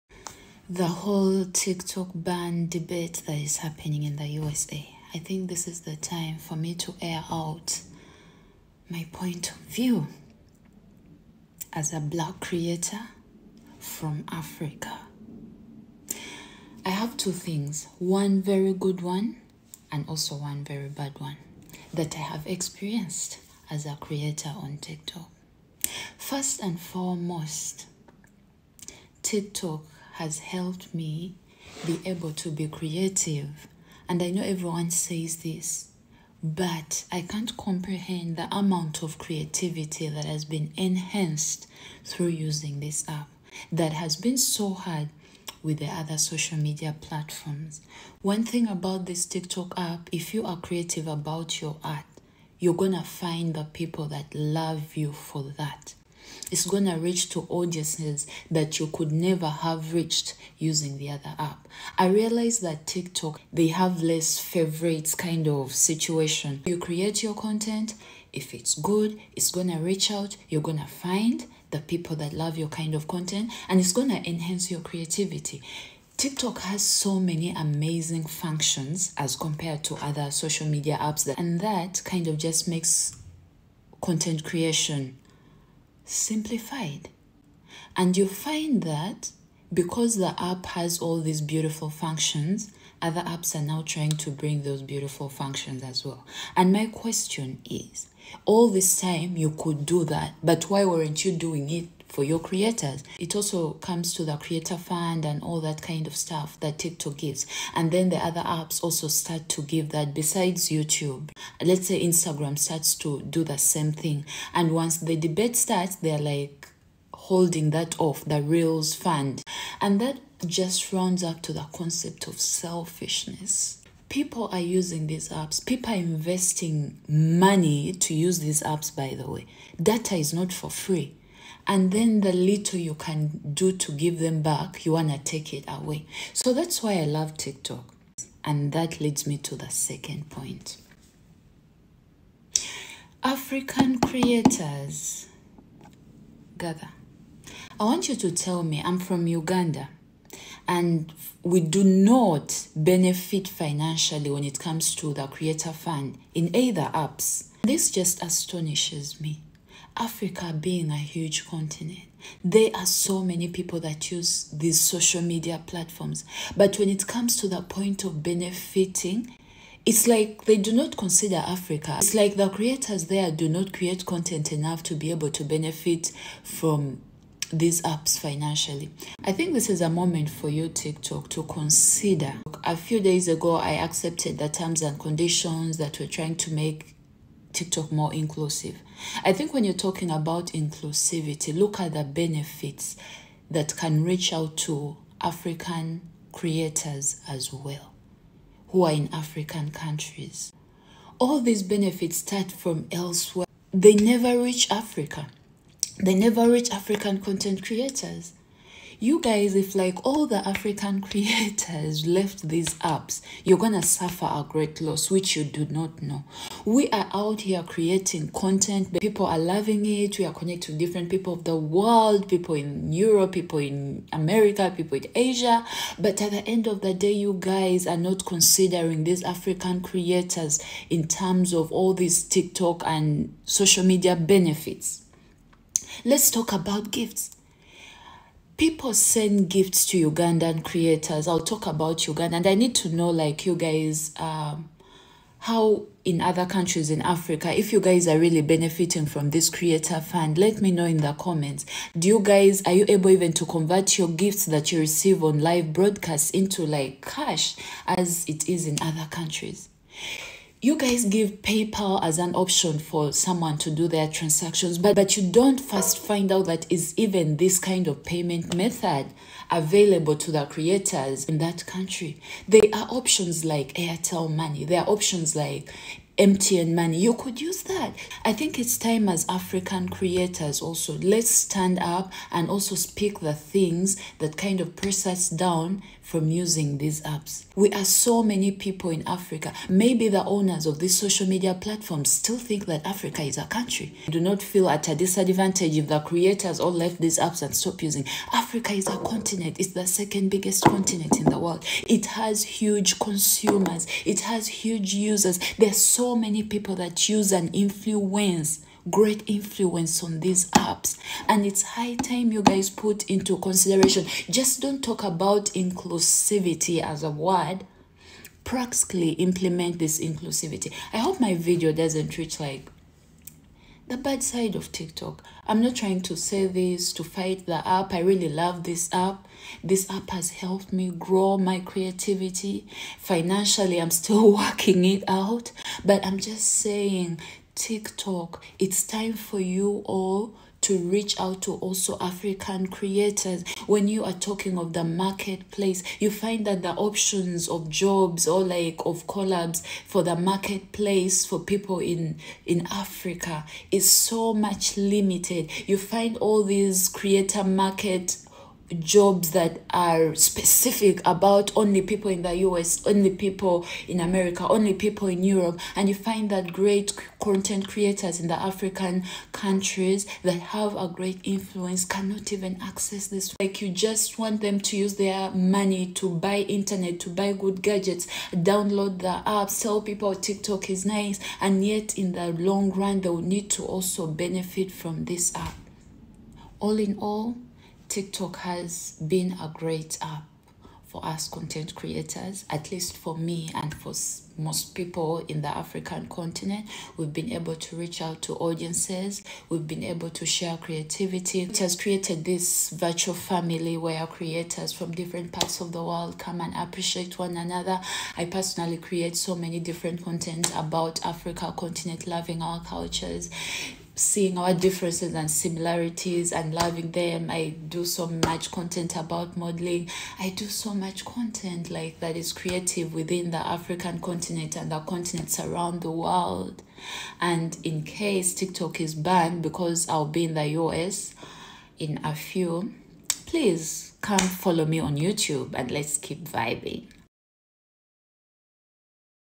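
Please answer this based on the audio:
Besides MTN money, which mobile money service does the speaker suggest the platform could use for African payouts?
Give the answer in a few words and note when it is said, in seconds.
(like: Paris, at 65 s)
Airtel Money, at 273 s.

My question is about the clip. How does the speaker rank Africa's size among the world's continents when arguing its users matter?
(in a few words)
Second biggest.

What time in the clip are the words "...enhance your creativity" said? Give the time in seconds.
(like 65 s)
74 s.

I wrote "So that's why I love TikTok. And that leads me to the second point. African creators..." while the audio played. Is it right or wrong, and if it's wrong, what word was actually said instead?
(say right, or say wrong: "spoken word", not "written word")
right.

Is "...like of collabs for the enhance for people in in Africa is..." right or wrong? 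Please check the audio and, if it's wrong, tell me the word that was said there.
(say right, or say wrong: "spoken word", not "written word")
wrong: "marketplace", not "enhance".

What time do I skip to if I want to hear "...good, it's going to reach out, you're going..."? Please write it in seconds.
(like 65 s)
68 s.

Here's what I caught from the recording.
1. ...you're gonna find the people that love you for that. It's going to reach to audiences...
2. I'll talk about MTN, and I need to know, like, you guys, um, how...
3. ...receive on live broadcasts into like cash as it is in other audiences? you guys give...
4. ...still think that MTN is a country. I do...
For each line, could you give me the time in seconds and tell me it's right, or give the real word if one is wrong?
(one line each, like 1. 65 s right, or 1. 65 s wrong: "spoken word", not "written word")
1. 52 s right
2. 241 s wrong: "Uganda", not "MTN"
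3. 254 s wrong: "countries", not "audiences"
4. 292 s wrong: "Africa", not "MTN".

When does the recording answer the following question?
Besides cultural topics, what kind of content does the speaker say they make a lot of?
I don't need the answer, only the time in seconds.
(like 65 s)
419 s.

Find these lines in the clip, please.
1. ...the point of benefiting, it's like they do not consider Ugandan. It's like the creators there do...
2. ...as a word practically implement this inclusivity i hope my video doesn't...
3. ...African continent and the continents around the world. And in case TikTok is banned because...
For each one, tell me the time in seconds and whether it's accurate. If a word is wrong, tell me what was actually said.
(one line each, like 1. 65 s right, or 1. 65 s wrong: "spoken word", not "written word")
1. 167 s wrong: "Africa", not "Ugandan"
2. 316 s right
3. 423 s right.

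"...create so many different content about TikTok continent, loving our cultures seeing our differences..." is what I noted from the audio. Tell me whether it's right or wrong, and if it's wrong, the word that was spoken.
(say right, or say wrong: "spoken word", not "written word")
wrong: "Africa", not "TikTok".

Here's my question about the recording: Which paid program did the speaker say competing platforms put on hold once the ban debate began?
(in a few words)
Reels fund.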